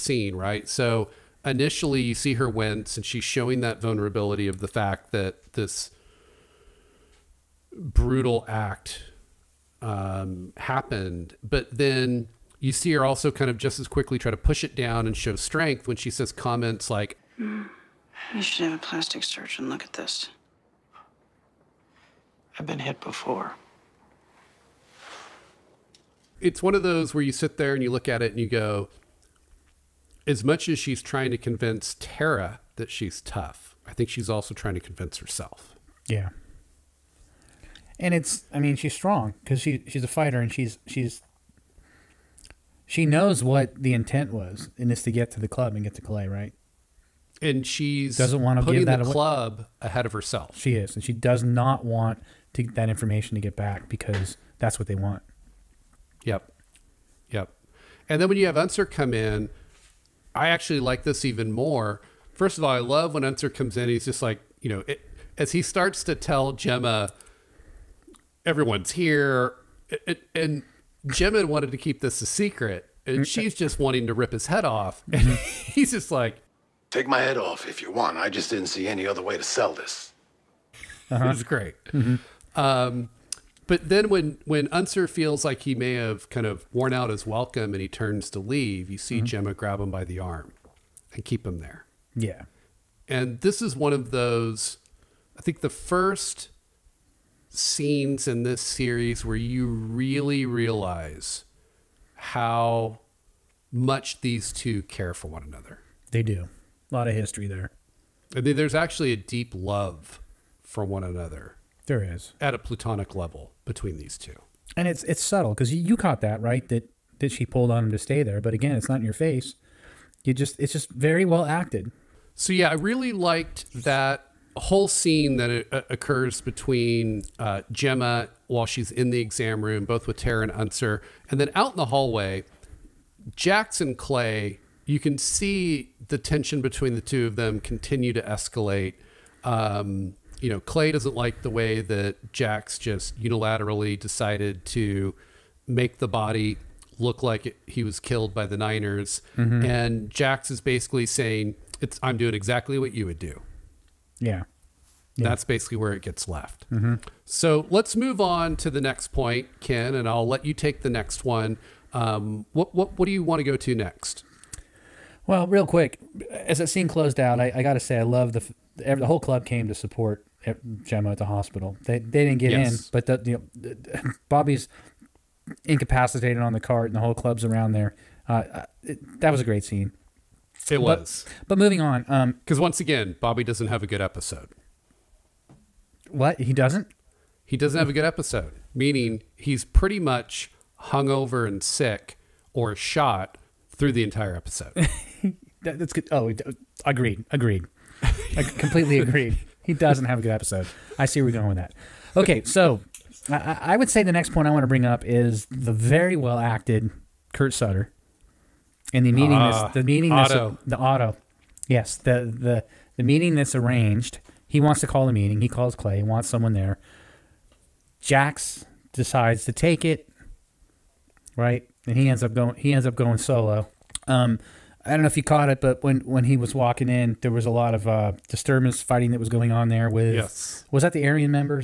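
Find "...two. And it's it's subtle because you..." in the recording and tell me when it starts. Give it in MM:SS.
01:54.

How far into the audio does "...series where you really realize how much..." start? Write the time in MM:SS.
01:38.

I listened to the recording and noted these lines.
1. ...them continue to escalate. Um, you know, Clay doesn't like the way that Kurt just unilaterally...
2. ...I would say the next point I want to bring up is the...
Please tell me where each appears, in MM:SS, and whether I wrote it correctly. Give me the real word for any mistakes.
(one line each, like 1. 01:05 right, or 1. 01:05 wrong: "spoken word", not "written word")
1. 02:17 wrong: "Jax", not "Kurt"
2. 03:23 right.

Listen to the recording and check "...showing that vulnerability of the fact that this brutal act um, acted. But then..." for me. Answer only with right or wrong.
wrong.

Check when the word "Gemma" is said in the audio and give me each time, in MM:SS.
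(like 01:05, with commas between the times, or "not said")
01:06, 01:11, 01:29, 02:07, 02:50.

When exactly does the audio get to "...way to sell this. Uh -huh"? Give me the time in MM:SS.
01:19.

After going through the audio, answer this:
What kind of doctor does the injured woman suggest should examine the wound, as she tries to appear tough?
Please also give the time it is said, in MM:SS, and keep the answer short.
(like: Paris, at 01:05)
plastic surgeon, at 00:18.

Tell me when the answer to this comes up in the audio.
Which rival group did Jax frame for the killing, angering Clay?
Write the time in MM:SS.
02:28.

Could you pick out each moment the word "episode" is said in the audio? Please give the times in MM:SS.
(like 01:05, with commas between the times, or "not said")
03:04, 03:08, 03:14, 03:20.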